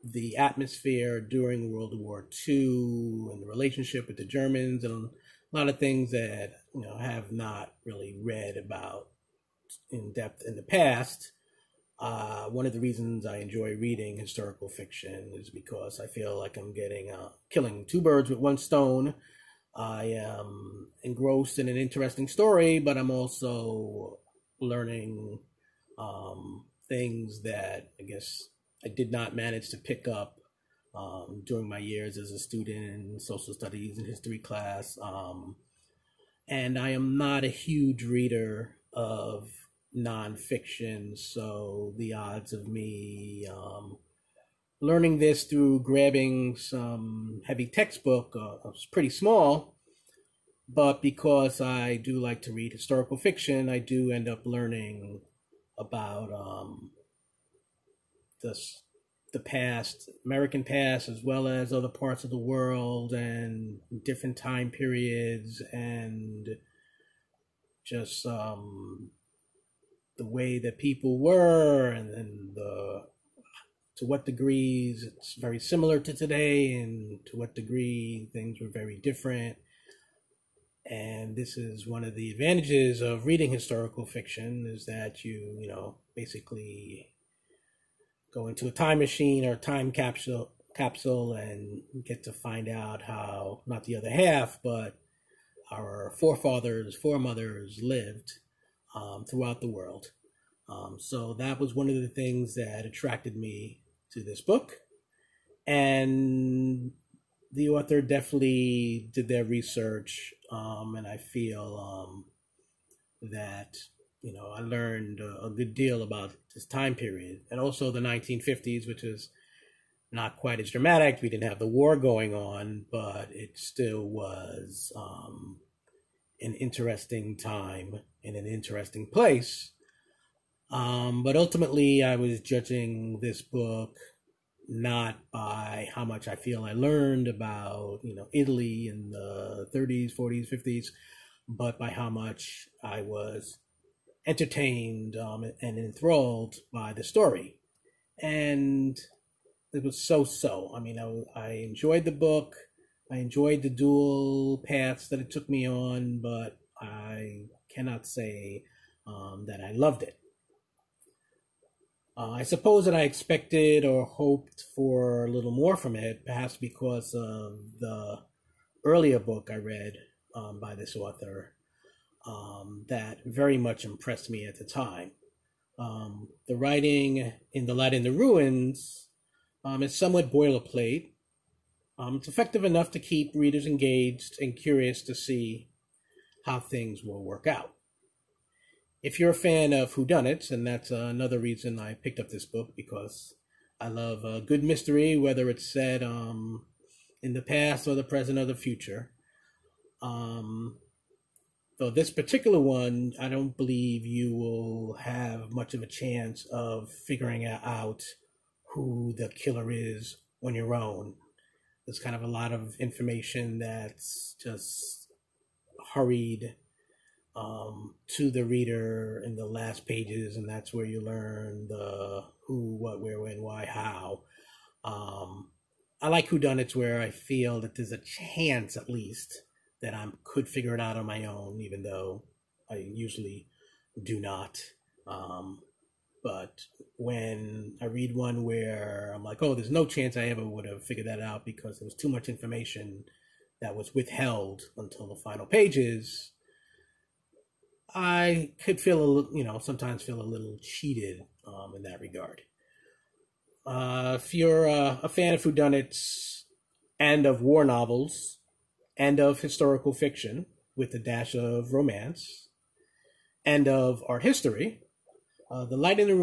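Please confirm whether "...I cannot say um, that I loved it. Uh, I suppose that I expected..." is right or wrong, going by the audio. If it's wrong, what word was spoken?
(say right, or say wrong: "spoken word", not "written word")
right.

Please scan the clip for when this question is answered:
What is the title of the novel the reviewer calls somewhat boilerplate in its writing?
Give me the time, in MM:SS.
02:57.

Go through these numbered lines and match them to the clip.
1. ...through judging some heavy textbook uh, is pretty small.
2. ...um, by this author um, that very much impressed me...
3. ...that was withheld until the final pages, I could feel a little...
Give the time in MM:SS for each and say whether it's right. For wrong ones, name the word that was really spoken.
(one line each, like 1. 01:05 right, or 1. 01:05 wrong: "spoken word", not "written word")
1. 00:45 wrong: "grabbing", not "judging"
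2. 02:50 right
3. 04:03 right.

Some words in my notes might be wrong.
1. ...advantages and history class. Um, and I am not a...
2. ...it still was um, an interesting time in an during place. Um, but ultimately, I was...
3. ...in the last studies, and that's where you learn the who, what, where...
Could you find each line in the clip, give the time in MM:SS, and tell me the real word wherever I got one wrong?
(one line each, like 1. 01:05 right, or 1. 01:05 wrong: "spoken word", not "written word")
1. 00:33 wrong: "studies", not "advantages"
2. 02:03 wrong: "interesting", not "during"
3. 03:39 wrong: "pages", not "studies".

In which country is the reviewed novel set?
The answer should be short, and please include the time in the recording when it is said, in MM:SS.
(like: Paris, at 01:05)
Italy, at 02:18.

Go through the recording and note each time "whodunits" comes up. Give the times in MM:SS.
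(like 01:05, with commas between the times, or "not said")
03:09, 03:46, 04:15.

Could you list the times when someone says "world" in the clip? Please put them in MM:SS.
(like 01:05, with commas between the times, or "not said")
00:01, 01:02, 01:39.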